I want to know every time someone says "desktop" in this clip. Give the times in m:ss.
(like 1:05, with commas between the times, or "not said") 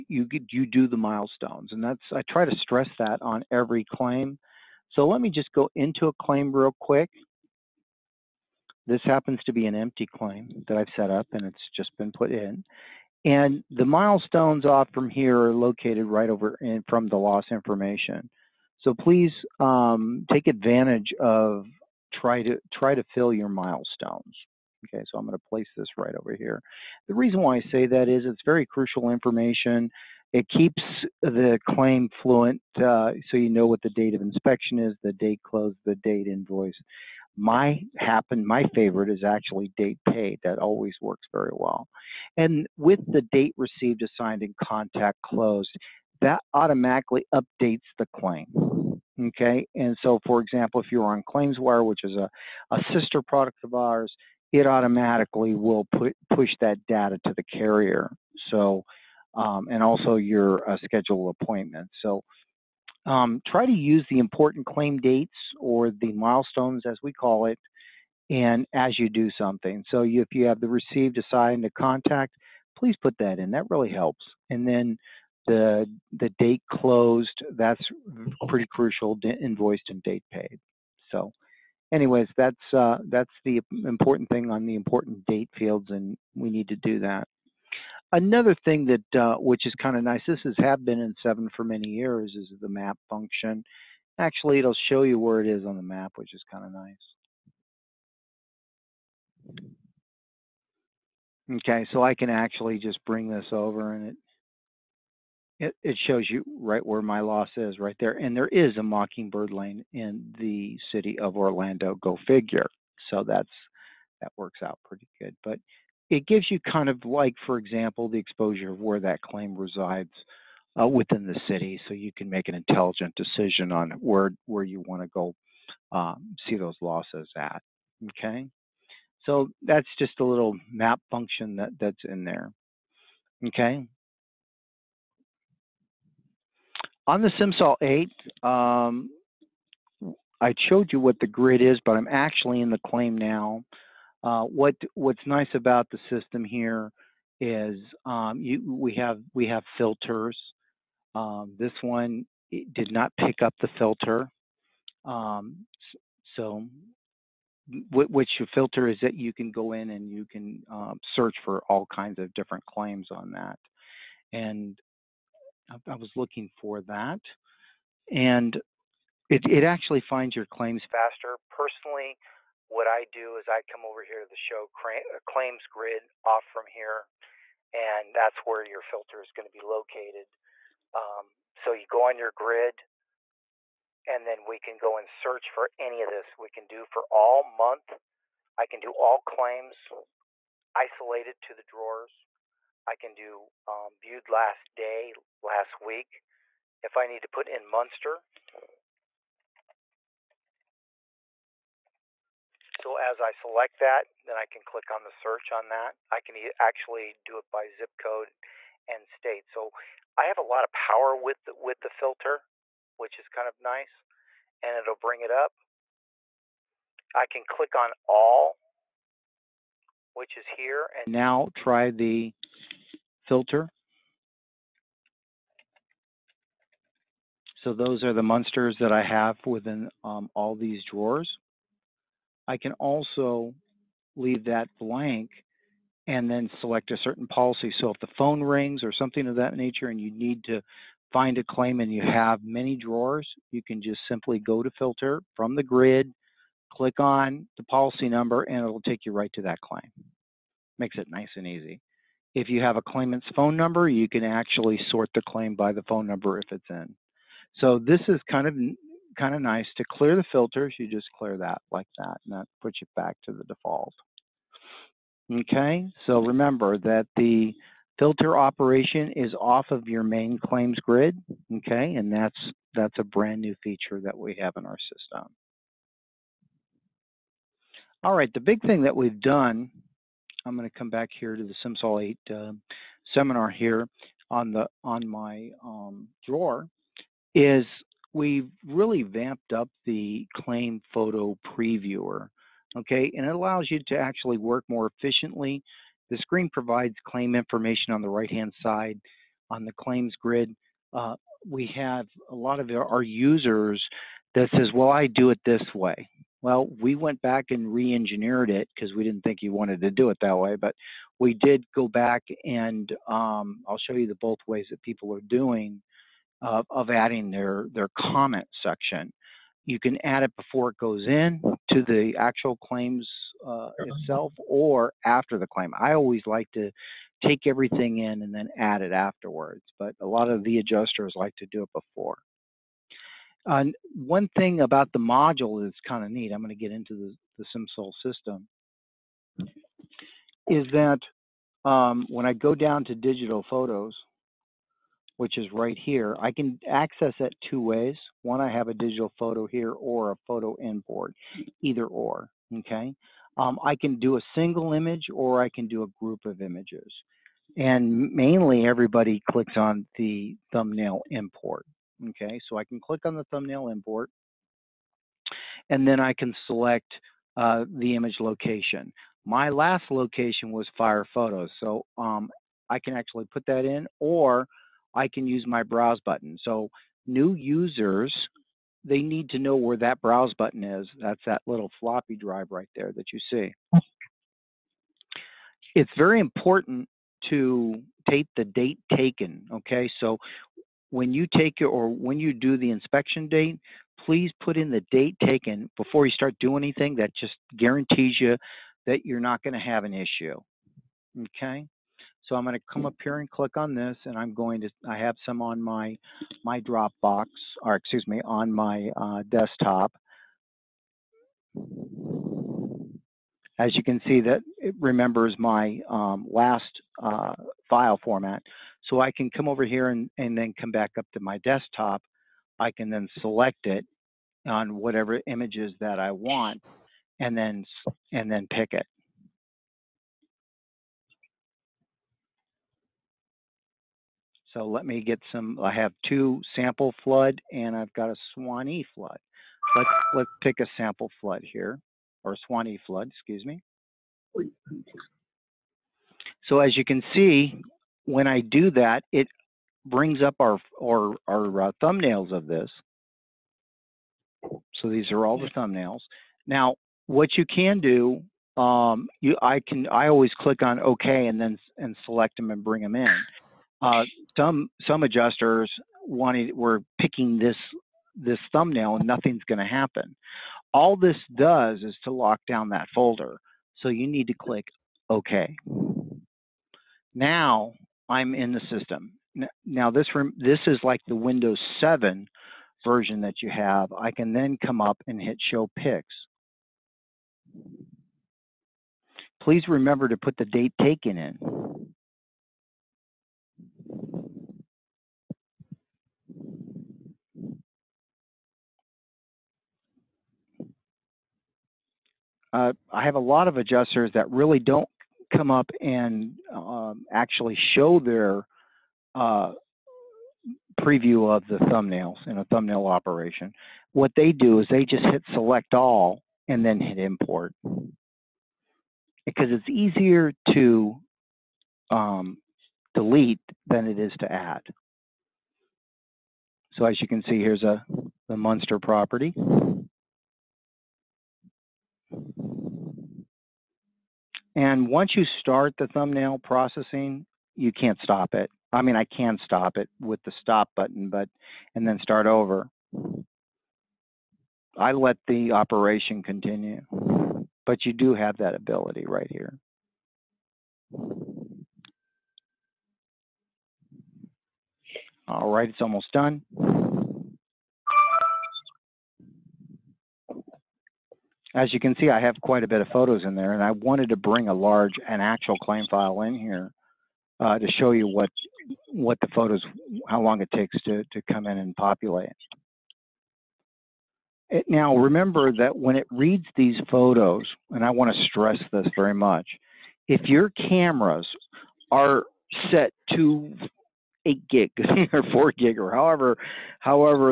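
6:49, 7:01.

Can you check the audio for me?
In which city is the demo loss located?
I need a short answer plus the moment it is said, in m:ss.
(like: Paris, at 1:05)
Orlando, at 1:51.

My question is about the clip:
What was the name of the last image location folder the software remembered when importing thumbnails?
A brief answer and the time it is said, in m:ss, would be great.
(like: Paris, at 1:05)
Fire Photos, at 6:10.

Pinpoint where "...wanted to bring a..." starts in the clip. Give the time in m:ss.
9:23.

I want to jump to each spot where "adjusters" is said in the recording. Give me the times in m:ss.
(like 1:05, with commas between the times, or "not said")
5:30, 7:45, 8:23.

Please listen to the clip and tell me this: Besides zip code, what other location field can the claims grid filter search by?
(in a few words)
State.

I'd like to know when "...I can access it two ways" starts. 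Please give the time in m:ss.
5:46.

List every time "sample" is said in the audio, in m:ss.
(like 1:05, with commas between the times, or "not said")
7:16, 7:20.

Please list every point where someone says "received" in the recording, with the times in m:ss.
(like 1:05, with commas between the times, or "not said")
0:43, 1:10.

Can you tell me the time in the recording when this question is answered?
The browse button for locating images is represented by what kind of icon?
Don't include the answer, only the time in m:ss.
6:21.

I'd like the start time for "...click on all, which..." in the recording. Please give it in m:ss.
3:37.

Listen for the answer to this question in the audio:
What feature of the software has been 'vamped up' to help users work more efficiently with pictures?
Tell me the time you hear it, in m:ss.
4:50.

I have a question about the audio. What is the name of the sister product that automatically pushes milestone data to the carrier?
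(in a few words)
ClaimsWire.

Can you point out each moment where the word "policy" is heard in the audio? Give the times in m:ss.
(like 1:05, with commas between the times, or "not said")
3:57, 4:07.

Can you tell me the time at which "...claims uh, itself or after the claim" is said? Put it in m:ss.
5:22.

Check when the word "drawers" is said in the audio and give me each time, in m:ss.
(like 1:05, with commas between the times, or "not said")
3:11, 3:50, 4:02, 4:46.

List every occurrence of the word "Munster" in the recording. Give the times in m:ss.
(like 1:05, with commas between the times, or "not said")
3:17, 8:48.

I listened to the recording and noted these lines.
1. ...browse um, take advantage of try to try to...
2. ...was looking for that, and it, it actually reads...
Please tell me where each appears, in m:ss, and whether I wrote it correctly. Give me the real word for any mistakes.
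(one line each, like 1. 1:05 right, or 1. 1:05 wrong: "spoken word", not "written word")
1. 0:18 wrong: "please", not "browse"
2. 2:45 wrong: "finds", not "reads".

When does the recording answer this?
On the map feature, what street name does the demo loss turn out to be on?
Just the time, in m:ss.
1:48.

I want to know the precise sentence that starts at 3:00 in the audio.
Um, so you go on your grid, and then we can go and search for any of this.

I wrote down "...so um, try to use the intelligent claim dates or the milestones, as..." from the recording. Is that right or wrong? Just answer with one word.
wrong.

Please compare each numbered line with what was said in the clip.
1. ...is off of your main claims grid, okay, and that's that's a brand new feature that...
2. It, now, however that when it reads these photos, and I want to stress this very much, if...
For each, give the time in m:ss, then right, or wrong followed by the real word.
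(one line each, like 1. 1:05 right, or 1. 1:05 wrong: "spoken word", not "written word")
1. 4:29 right
2. 9:34 wrong: "remember", not "however".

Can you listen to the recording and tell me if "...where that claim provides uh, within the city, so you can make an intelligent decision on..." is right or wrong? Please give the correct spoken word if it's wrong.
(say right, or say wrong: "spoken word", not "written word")
wrong: "resides", not "provides".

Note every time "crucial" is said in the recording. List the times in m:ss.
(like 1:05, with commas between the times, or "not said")
0:28, 1:18.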